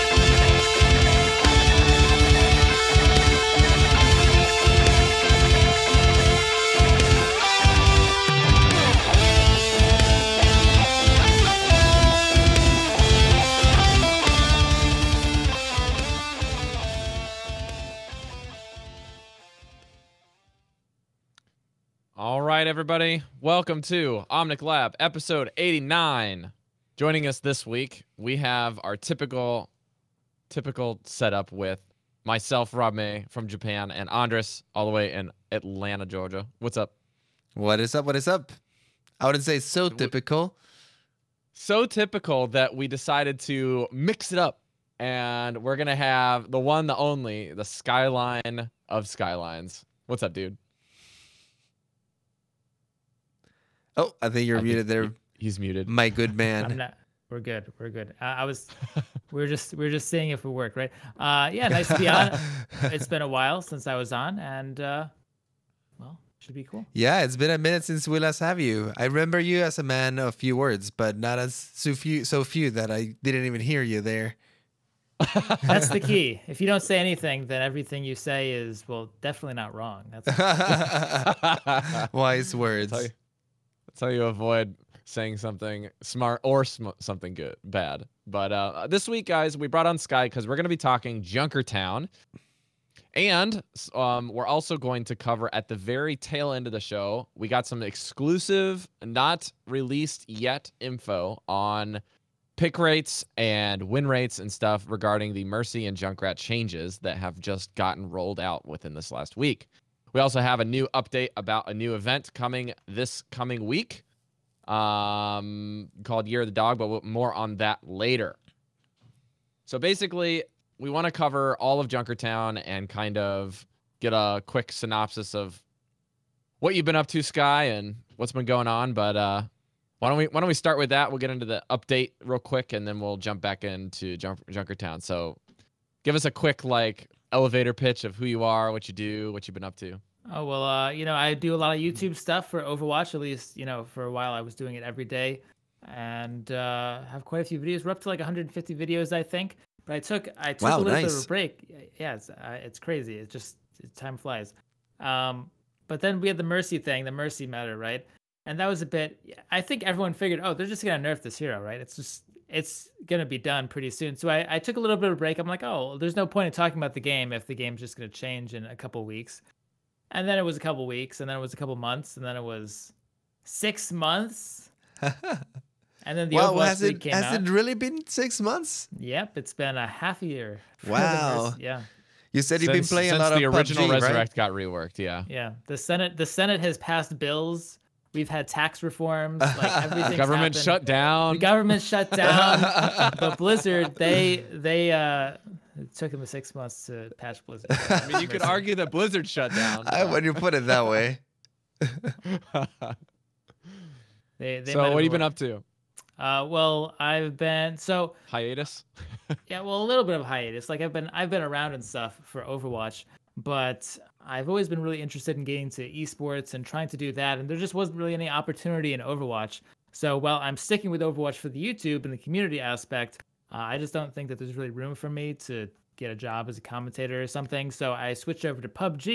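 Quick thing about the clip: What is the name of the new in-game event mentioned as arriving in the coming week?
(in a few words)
Year of the Dog.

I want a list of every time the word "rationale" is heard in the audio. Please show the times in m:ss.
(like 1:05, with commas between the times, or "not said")
not said.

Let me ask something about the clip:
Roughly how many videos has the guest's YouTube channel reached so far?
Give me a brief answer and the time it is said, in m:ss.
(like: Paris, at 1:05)
150, at 2:28.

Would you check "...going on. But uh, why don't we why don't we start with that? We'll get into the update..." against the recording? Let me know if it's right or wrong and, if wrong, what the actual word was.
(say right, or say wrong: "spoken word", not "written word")
right.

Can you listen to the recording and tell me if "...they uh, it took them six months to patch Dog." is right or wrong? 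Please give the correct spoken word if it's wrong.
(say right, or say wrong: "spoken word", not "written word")
wrong: "Blizzard", not "Dog".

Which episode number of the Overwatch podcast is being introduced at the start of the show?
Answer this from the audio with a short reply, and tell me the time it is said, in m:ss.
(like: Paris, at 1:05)
89, at 0:24.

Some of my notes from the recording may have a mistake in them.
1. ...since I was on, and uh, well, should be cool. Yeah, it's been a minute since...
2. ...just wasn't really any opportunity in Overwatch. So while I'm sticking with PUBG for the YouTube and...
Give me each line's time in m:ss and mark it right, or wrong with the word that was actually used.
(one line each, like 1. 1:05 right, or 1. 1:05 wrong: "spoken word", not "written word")
1. 1:03 right
2. 3:37 wrong: "Overwatch", not "PUBG".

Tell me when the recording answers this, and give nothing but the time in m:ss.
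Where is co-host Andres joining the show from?
0:35.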